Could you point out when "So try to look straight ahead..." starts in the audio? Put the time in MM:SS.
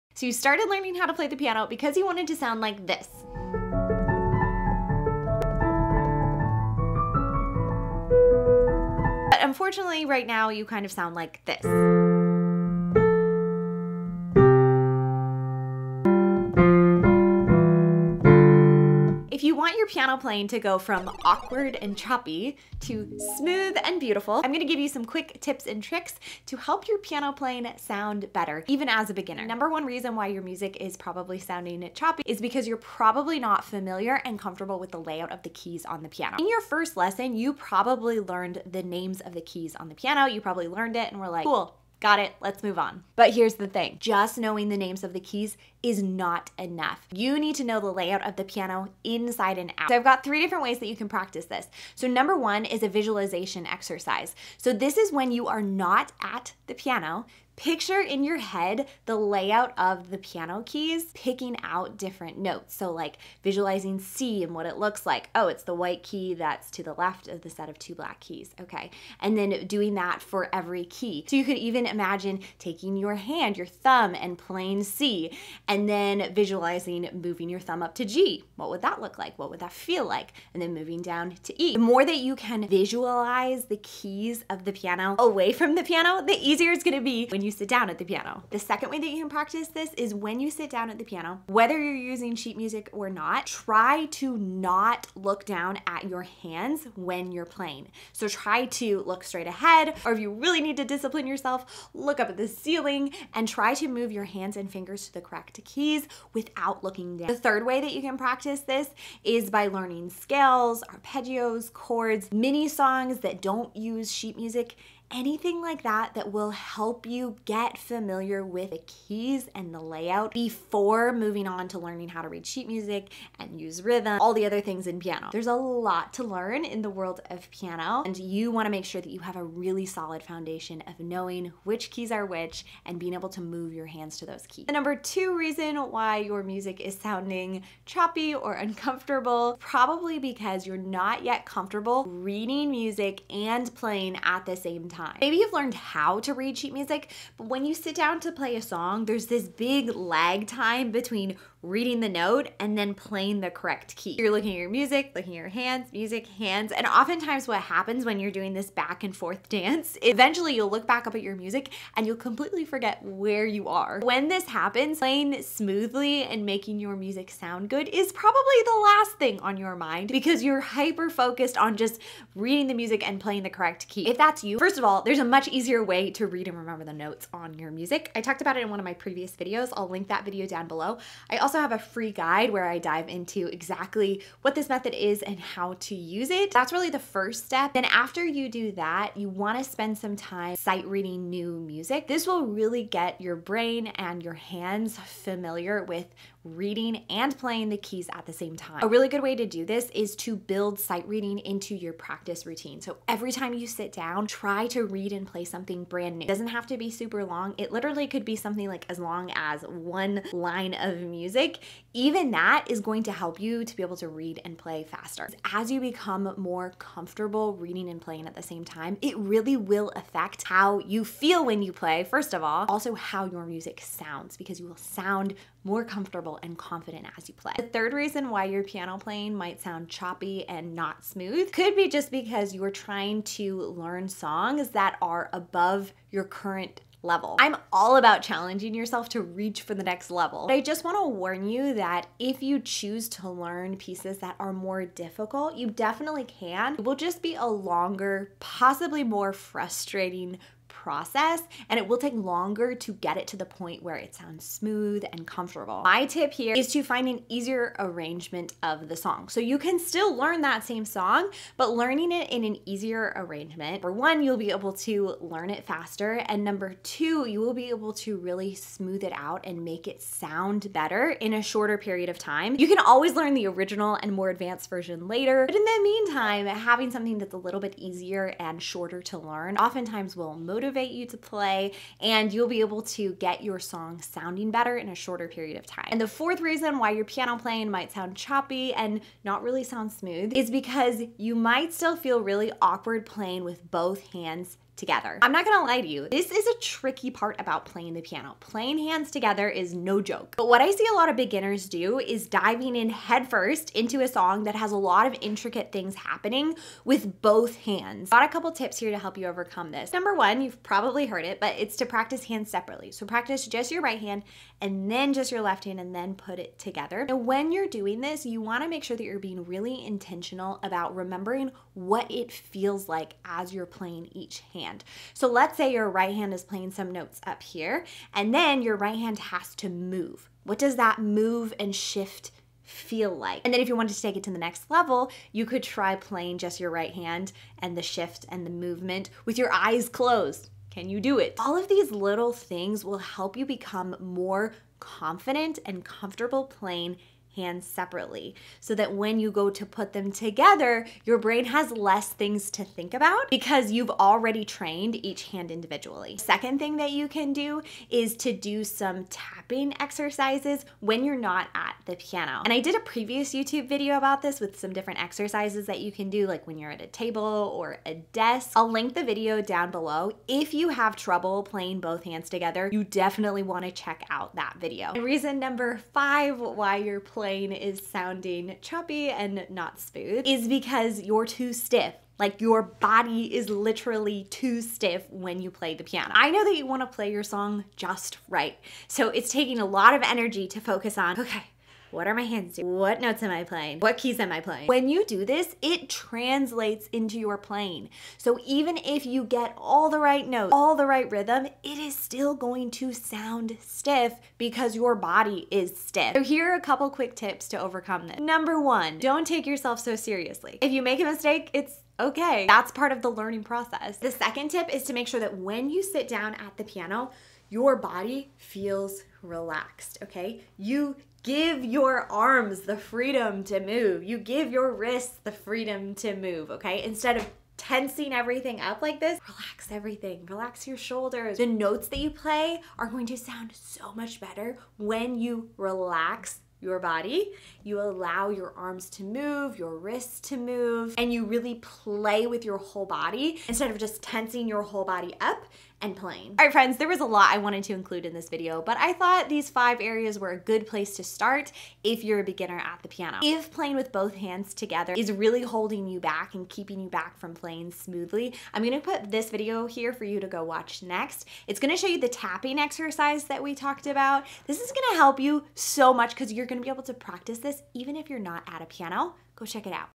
01:38.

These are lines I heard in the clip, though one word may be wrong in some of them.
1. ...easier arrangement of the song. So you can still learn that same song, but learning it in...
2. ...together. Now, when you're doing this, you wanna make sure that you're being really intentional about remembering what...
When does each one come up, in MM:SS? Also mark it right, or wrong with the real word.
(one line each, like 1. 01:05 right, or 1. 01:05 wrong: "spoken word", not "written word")
1. 04:17 right
2. 05:16 right.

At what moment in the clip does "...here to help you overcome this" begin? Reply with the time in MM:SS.
05:08.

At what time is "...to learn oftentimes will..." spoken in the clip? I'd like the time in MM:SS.
04:39.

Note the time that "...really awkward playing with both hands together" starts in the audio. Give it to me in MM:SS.
04:52.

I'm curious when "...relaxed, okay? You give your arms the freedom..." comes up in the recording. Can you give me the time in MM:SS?
06:59.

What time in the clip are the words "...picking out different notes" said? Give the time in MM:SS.
01:01.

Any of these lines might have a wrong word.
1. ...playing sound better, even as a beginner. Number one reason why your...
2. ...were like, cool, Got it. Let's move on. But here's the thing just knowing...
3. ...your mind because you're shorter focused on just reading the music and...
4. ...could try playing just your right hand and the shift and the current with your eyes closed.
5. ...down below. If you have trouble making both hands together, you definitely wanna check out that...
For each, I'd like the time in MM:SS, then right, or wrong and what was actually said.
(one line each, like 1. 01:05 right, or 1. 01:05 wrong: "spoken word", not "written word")
1. 00:27 right
2. 00:41 right
3. 02:49 wrong: "hyper", not "shorter"
4. 05:35 wrong: "movement", not "current"
5. 06:09 wrong: "playing", not "making".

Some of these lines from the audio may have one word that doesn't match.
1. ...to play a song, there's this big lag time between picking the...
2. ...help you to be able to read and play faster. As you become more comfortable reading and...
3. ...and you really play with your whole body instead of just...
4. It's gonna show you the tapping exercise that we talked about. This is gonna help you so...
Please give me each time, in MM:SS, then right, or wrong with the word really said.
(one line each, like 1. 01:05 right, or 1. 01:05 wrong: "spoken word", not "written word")
1. 02:28 wrong: "reading", not "picking"
2. 03:33 right
3. 07:20 right
4. 07:41 right.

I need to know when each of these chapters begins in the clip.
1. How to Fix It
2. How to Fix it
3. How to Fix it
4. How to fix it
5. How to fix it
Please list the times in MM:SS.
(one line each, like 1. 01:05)
1. 00:51
2. 02:55
3. 04:17
4. 05:11
5. 06:48.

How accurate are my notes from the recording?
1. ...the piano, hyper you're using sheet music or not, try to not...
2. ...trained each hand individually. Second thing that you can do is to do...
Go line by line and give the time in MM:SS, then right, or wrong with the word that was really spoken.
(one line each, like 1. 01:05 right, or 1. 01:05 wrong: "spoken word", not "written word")
1. 01:30 wrong: "whether", not "hyper"
2. 05:54 right.